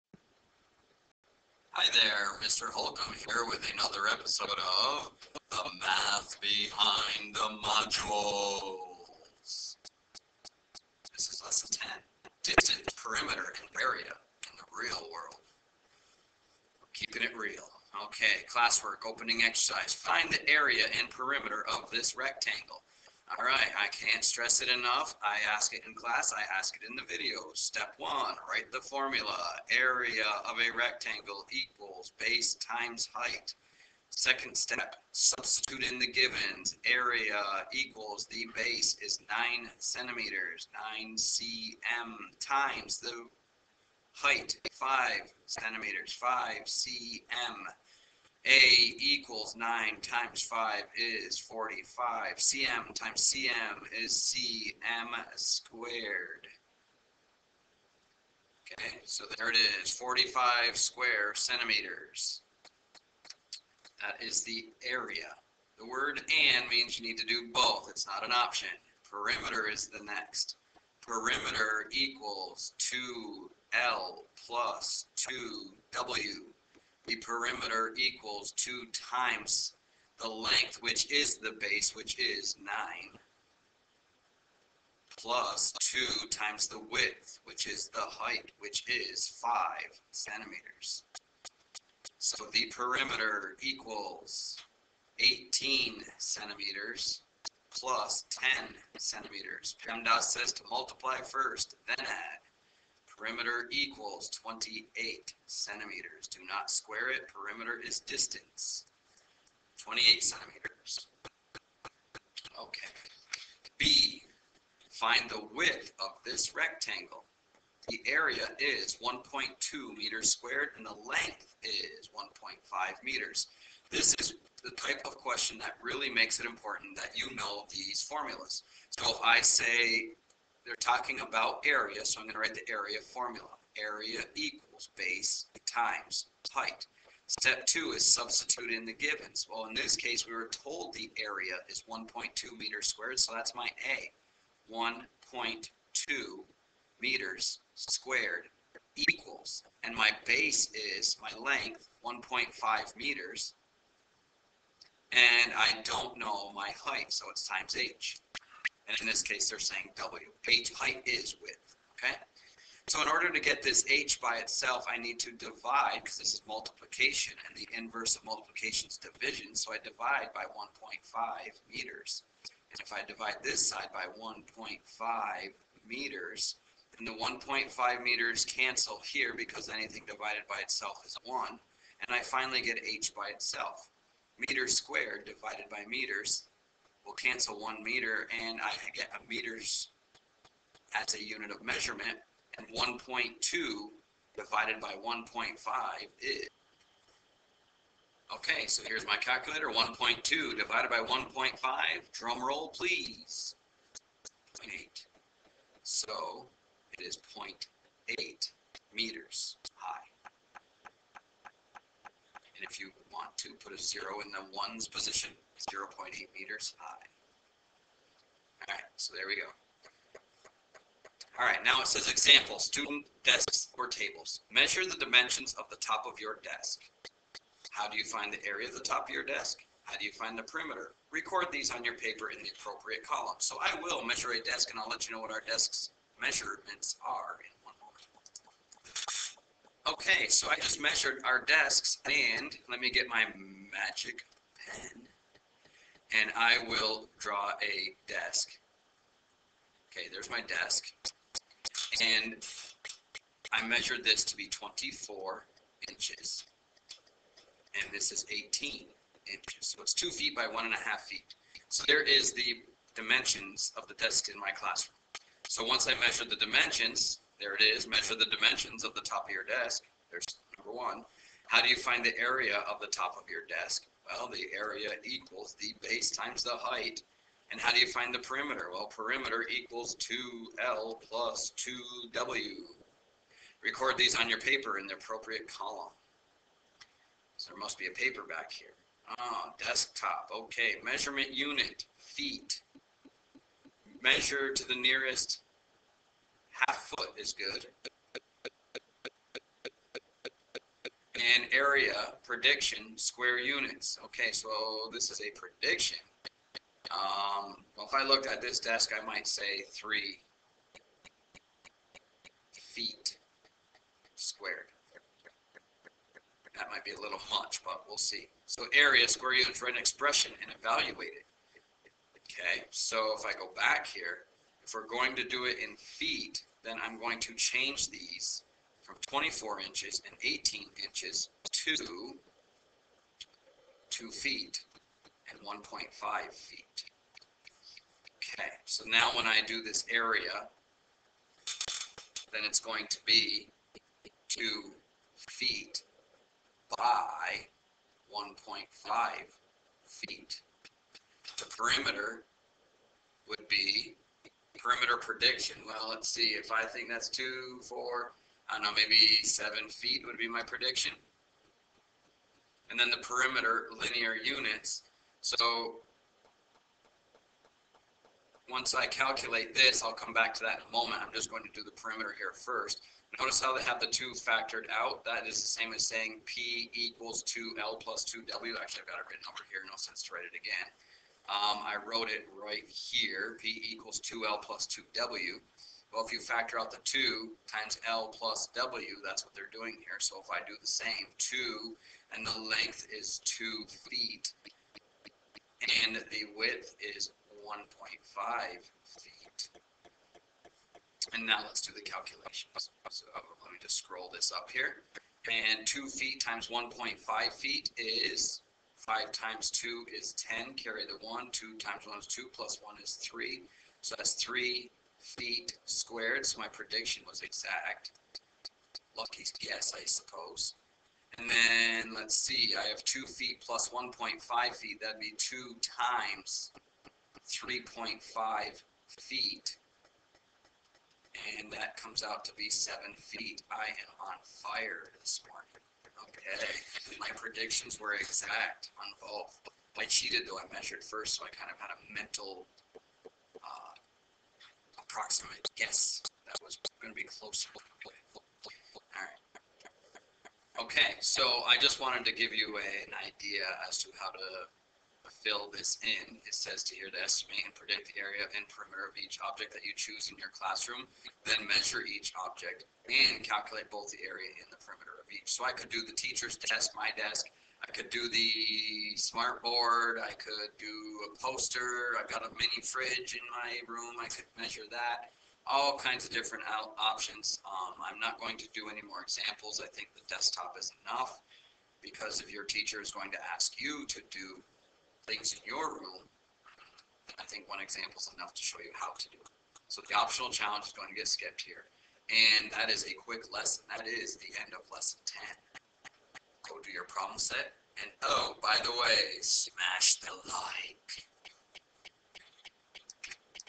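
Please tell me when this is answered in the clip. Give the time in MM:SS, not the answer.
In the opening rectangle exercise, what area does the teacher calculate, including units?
00:59.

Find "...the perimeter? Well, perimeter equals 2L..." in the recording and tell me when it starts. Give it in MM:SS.
04:38.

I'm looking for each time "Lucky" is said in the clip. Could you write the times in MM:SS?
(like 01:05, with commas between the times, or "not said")
06:58.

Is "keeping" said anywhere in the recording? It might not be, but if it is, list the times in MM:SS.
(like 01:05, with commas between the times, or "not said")
00:16.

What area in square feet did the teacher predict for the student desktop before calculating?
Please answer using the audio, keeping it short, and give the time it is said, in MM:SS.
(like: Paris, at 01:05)
3, at 05:09.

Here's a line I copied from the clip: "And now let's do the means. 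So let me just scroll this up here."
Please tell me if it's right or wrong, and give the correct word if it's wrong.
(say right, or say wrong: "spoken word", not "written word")
wrong: "calculations", not "means".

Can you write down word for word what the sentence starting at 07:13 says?
I am on fire this morning okay.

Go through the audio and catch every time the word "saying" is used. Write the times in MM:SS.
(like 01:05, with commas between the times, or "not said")
02:39, 06:15.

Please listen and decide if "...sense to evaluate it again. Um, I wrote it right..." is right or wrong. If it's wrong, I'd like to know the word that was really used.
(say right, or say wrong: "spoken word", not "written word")
wrong: "write", not "evaluate".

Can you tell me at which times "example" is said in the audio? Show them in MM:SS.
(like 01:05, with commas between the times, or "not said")
03:42, 07:59, 08:07.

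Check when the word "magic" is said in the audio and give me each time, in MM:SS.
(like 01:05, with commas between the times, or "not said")
04:03.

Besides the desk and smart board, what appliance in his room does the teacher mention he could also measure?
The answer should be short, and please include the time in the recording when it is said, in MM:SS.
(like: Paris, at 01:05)
mini fridge, at 07:52.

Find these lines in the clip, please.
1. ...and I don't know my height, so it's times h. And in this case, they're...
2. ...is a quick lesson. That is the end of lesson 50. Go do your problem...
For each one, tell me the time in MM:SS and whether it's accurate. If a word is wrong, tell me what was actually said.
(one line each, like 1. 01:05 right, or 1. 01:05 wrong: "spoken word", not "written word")
1. 02:35 right
2. 08:12 wrong: "10", not "50".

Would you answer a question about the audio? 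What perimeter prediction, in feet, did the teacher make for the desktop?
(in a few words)
7 feet.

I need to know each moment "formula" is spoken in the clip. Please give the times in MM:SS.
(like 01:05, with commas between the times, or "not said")
00:28, 02:08, 02:13.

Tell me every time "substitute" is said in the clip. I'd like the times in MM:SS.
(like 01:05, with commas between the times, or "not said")
00:35, 02:18.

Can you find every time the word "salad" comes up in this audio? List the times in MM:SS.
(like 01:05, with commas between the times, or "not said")
not said.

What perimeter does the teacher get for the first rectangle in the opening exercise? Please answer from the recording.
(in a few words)
28 centimeters.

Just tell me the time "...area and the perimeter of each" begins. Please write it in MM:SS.
07:44.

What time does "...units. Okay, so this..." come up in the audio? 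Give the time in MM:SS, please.
05:03.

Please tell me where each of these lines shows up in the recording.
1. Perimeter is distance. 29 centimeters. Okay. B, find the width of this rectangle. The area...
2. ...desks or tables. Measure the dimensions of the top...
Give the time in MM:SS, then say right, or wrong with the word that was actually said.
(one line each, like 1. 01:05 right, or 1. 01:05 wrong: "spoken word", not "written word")
1. 01:47 wrong: "28", not "29"
2. 03:43 right.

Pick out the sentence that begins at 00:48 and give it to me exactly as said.
A equals 9 times 5 is 45.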